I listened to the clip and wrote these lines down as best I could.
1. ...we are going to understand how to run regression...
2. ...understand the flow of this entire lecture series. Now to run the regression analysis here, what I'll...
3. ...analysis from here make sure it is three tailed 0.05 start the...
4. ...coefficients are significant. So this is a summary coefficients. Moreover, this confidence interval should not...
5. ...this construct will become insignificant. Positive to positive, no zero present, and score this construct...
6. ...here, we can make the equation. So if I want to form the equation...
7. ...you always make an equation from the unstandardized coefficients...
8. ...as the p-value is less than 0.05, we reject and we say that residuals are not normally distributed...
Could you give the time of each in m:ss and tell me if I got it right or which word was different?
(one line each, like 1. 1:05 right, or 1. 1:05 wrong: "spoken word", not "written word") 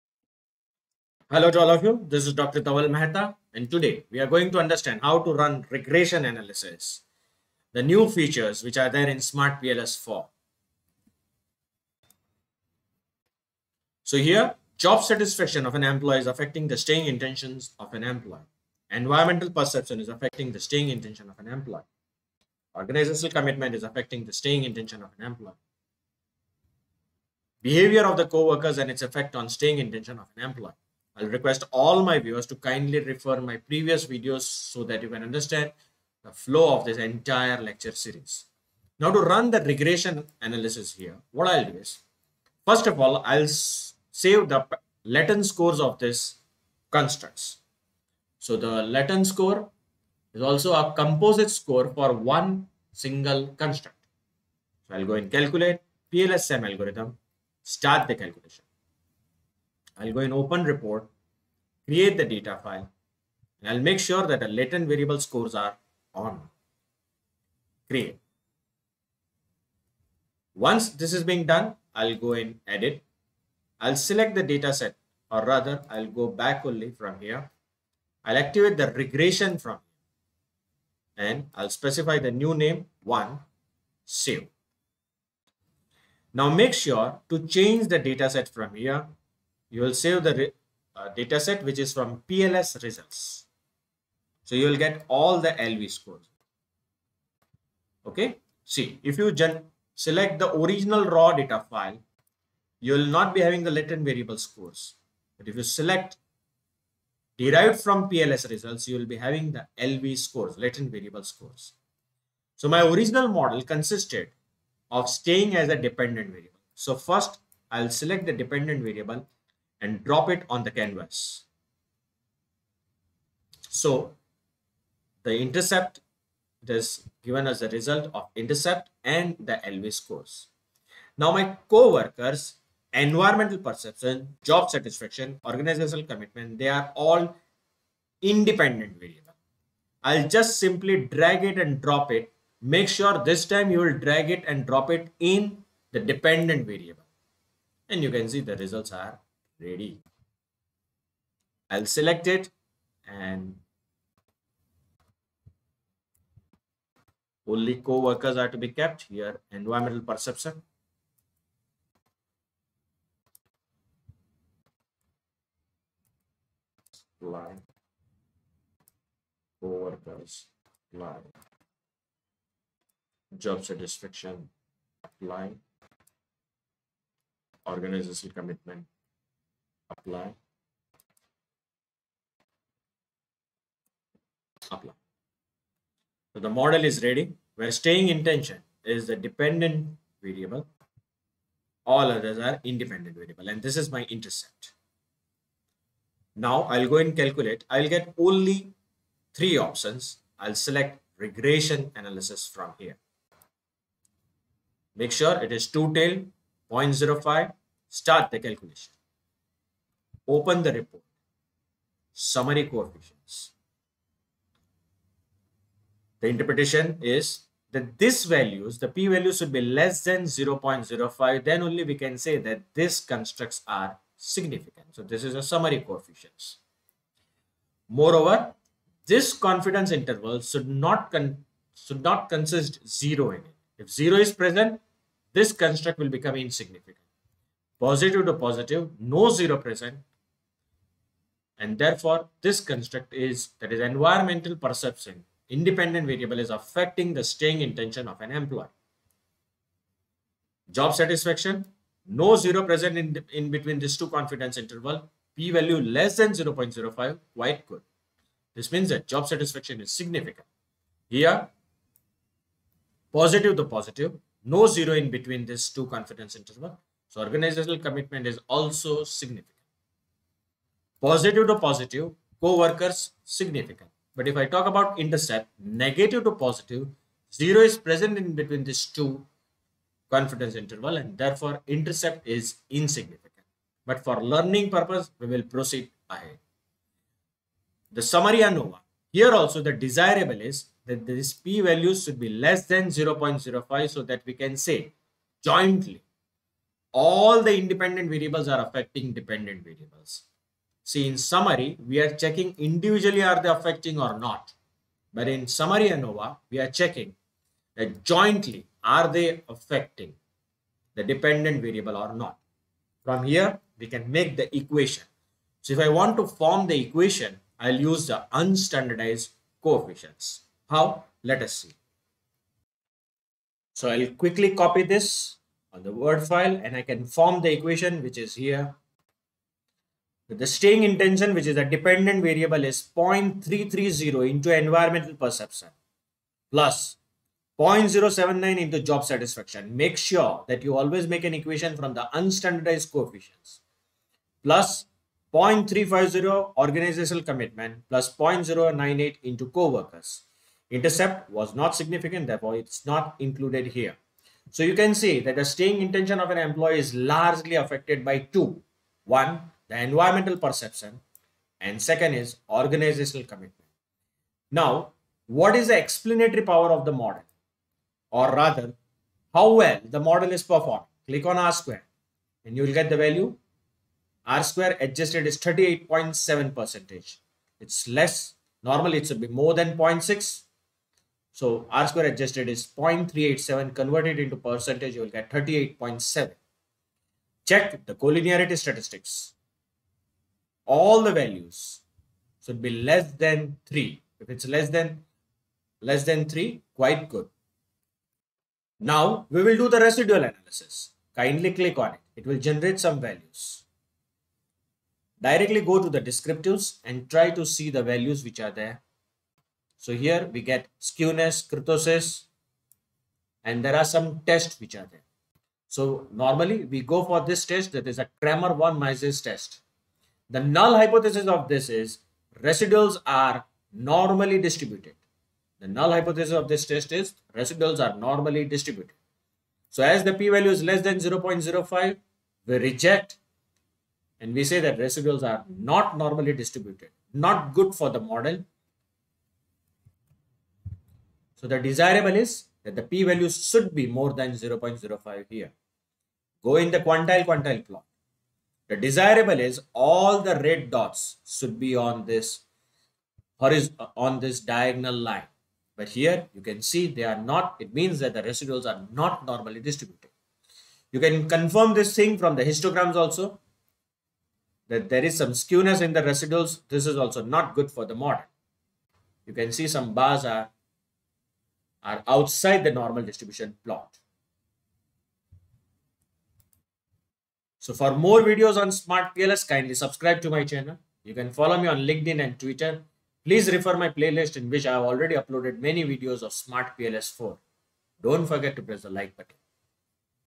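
1. 0:04 right
2. 0:35 right
3. 3:22 wrong: "two", not "three"
4. 3:42 wrong: "constructs", not "coefficients"
5. 3:55 wrong: "therefore", not "score"
6. 5:13 right
7. 5:40 right
8. 7:09 right.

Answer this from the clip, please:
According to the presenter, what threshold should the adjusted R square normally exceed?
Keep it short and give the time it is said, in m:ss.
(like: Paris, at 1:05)
0.6, at 6:19.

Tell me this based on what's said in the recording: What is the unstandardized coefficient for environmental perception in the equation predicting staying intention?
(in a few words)
0.330.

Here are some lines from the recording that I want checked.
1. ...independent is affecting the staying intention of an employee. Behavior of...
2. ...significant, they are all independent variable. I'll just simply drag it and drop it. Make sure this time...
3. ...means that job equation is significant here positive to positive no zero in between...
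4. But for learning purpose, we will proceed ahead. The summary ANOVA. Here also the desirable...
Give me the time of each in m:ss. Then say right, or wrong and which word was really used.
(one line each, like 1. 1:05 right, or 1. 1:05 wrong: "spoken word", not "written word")
1. 0:23 wrong: "commitment", not "independent"
2. 2:16 wrong: "commitment", not "significant"
3. 4:18 wrong: "satisfaction", not "equation"
4. 4:43 right.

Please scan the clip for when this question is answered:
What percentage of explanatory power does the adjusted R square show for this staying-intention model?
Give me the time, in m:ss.
6:15.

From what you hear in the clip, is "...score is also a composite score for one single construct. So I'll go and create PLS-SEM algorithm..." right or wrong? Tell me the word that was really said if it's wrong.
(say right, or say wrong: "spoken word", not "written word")
wrong: "calculate", not "create".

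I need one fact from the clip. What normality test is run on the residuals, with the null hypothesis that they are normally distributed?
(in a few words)
Cramér-von Mises test.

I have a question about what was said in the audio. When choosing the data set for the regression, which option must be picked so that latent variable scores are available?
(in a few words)
Derived from PLS results.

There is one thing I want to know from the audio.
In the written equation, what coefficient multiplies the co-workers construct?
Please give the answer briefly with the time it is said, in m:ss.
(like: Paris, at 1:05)
0.098, at 5:48.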